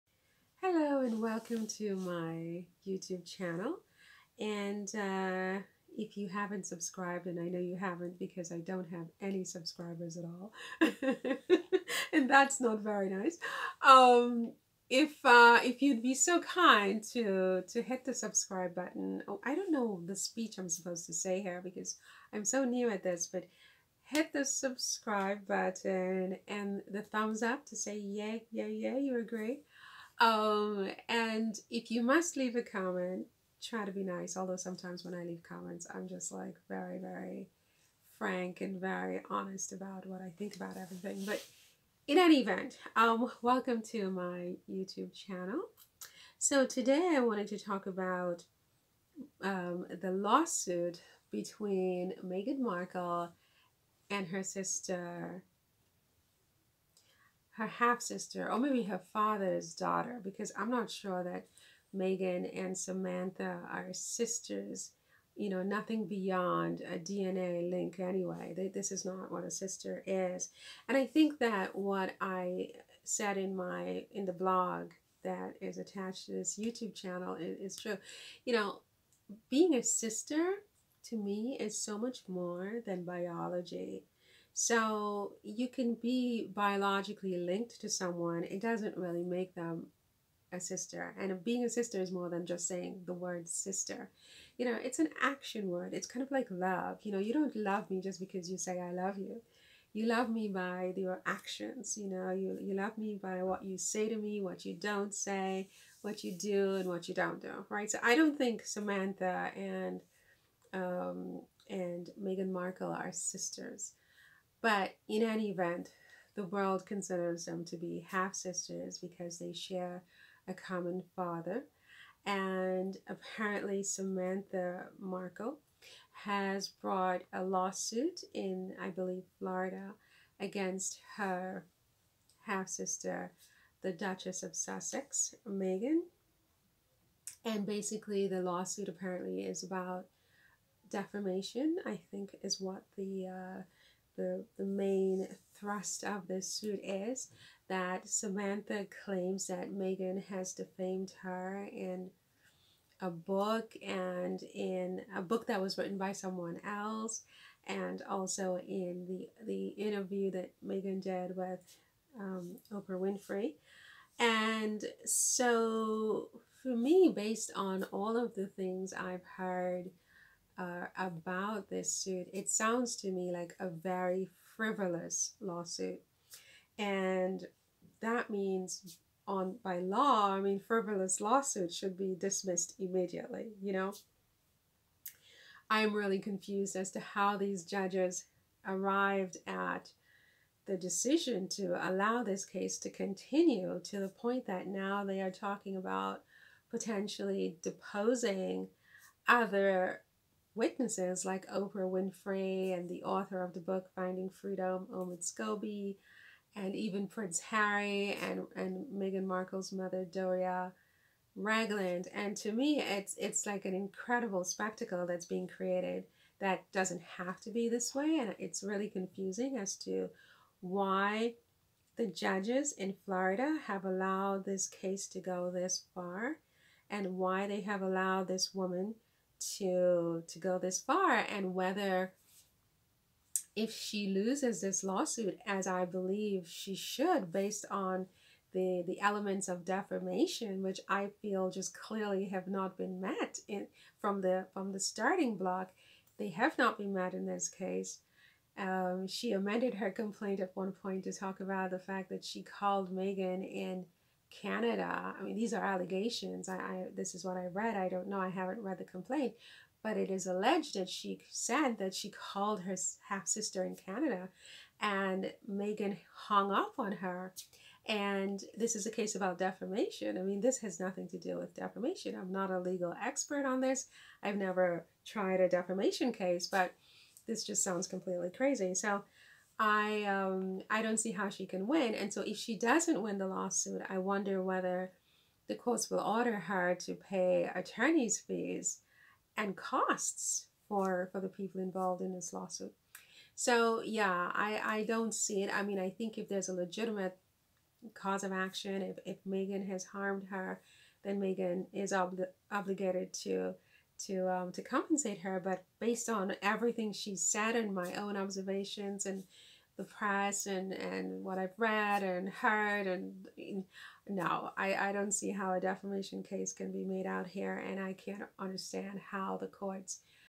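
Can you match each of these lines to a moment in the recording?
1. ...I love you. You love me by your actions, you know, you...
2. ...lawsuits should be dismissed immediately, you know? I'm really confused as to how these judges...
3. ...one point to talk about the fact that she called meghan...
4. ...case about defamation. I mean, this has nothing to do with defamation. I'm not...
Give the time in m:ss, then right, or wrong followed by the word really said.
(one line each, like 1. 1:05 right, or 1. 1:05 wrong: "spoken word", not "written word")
1. 1:38 right
2. 3:01 right
3. 4:10 right
4. 4:28 right.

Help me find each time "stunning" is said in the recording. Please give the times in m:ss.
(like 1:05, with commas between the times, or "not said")
not said.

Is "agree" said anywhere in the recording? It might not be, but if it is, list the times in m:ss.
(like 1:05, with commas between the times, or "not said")
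0:29.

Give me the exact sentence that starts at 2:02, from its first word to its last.
And apparently, Samantha Markle has brought a lawsuit in, I believe, Florida against her half sister, the Duchess of Sussex, Meghan.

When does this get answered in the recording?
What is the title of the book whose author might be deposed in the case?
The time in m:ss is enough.
3:23.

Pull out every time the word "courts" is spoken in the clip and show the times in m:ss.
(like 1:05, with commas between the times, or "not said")
4:45, 5:19.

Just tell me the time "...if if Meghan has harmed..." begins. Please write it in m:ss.
4:58.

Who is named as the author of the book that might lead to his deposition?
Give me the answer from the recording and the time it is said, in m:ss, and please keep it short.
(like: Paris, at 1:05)
Omid Scobie, at 3:24.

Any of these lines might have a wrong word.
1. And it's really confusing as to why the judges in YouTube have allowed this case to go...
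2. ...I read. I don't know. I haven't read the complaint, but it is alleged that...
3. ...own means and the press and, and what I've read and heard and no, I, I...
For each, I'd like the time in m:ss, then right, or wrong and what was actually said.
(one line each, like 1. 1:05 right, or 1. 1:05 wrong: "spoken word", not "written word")
1. 3:38 wrong: "Florida", not "YouTube"
2. 4:17 right
3. 5:07 wrong: "observations", not "means".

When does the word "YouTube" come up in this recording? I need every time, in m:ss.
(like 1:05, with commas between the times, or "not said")
0:02, 0:44, 1:16.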